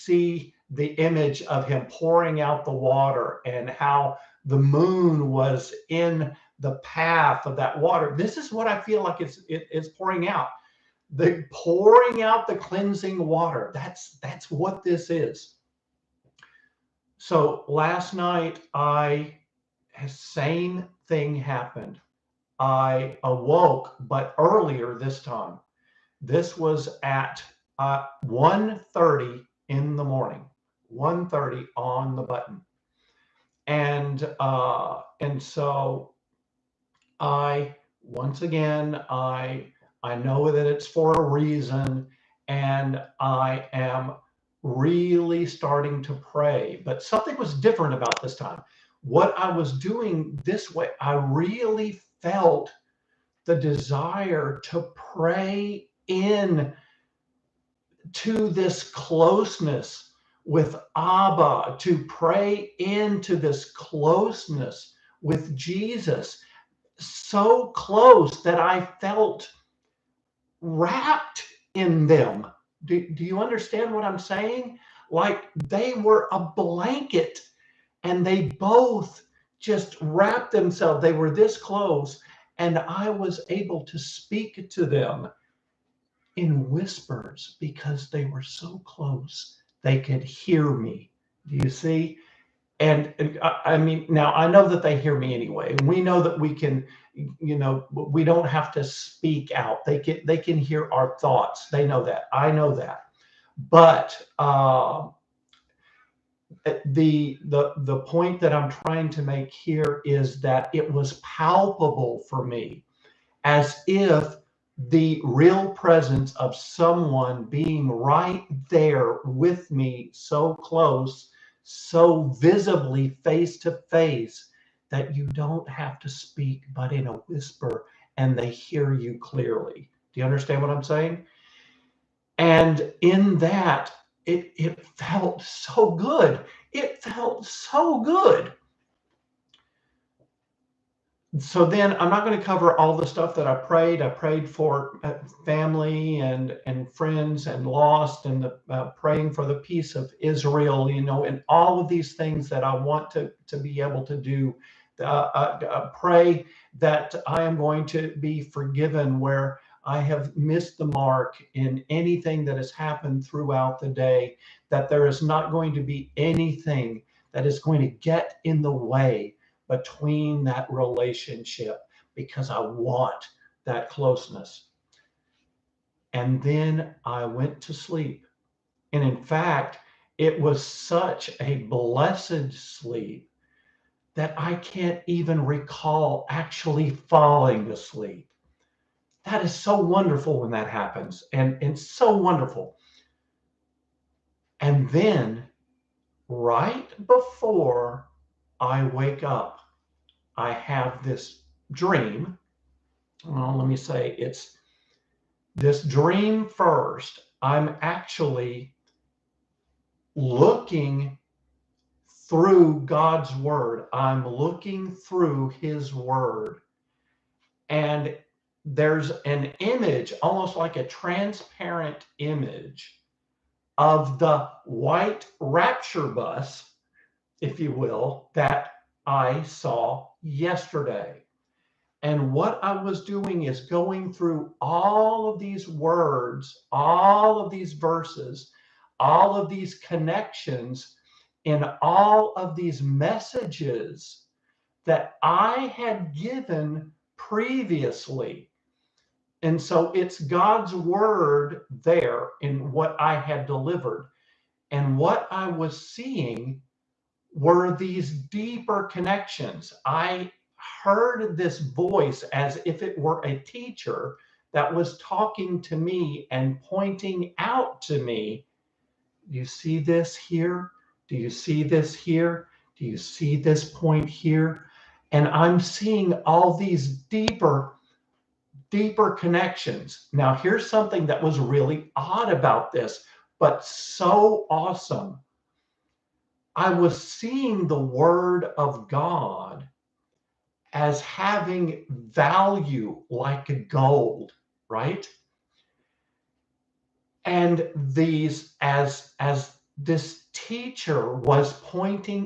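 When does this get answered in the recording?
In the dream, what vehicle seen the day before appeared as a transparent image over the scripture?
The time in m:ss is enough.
3:44.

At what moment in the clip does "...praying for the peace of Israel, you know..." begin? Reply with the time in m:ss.
2:28.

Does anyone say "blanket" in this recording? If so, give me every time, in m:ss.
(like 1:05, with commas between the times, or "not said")
1:16.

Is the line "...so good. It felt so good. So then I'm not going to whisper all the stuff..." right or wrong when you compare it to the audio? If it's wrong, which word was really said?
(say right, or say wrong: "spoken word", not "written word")
wrong: "cover", not "whisper".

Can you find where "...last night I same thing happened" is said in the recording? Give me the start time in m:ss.
0:17.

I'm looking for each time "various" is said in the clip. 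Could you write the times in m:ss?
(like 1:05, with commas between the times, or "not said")
not said.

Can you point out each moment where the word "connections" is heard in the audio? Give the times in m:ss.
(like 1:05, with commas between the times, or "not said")
3:59, 4:18, 4:39.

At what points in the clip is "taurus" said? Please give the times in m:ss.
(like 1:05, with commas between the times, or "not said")
not said.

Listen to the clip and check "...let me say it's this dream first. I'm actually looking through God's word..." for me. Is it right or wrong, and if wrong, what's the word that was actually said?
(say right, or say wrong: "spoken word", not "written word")
right.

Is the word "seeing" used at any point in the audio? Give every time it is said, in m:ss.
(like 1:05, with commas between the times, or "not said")
4:15, 4:35, 4:47.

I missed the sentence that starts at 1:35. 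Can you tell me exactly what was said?
We know that we can, you know, we don't have to speak out.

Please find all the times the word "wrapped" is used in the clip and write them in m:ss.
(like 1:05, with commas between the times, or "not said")
1:10, 1:19.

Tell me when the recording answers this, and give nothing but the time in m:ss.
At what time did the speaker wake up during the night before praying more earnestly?
0:30.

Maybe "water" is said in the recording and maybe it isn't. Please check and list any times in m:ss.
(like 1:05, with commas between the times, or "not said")
0:02, 0:07, 0:13.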